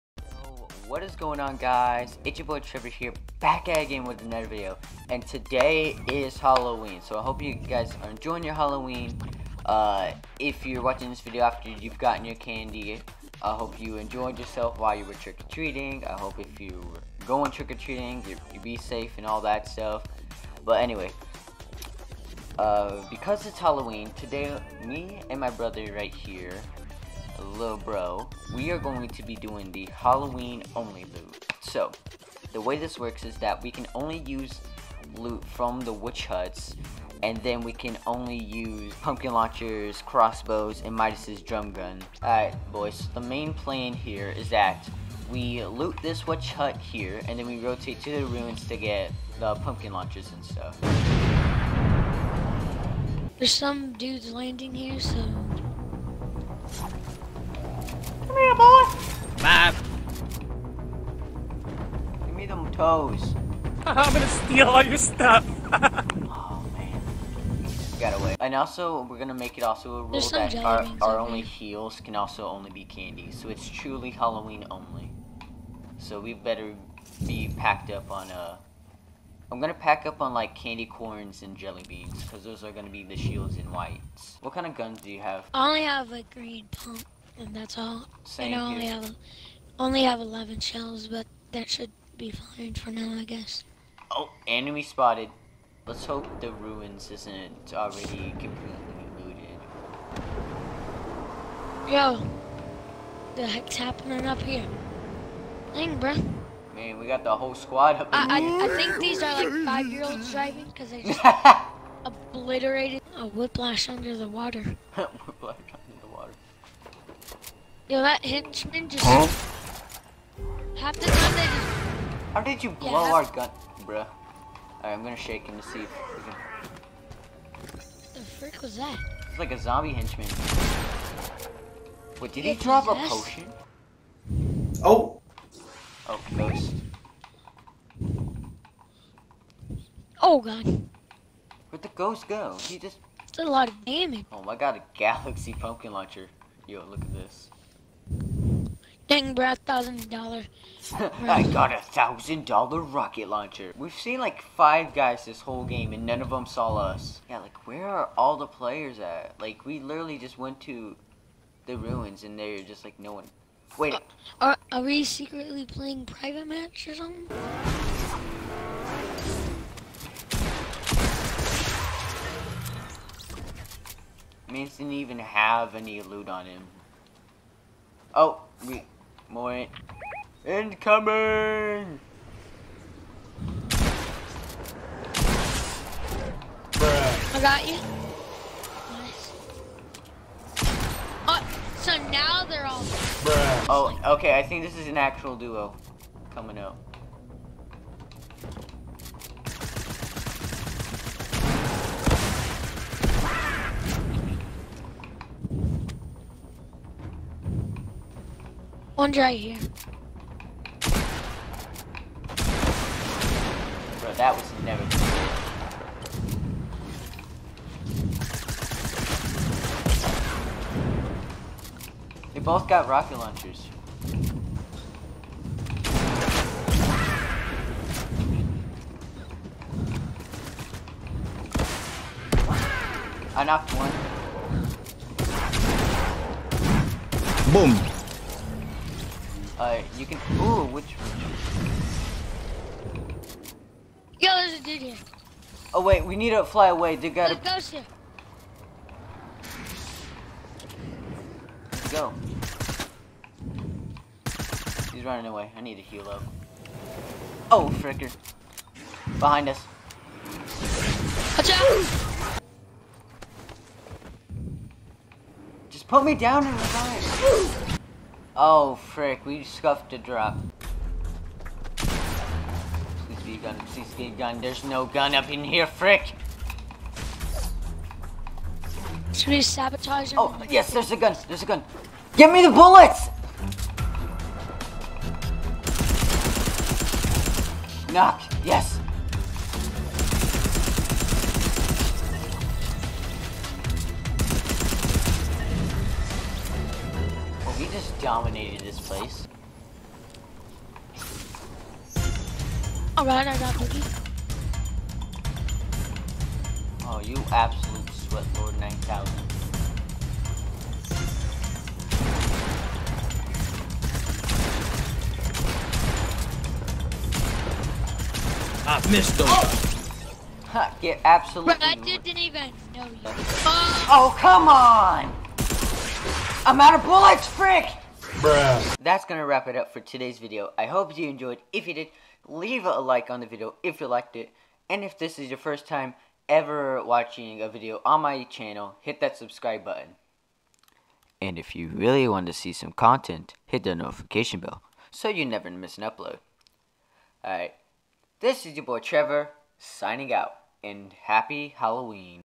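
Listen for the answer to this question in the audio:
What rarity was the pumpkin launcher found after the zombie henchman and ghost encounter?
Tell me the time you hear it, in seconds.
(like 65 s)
144 s.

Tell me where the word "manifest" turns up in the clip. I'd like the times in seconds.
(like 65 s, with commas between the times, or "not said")
not said.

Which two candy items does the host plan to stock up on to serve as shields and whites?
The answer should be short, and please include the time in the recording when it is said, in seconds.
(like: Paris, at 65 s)
candy corns and jelly beans, at 80 s.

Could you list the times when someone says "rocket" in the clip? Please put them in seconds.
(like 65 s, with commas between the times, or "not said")
152 s, 222 s.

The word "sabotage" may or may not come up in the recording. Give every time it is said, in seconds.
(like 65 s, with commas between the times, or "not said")
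279 s.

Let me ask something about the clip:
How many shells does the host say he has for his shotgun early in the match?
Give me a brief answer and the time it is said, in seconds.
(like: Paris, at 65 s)
11, at 90 s.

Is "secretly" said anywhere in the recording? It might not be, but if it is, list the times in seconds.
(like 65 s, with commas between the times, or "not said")
165 s.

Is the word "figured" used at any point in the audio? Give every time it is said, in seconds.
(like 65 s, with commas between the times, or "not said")
not said.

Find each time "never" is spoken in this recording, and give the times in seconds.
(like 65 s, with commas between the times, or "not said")
214 s, 345 s.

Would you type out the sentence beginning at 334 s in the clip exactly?
And if this is your first time ever watching a video on my channel, hit that subscribe button.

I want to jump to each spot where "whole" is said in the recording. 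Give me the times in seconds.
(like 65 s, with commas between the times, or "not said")
107 s, 155 s.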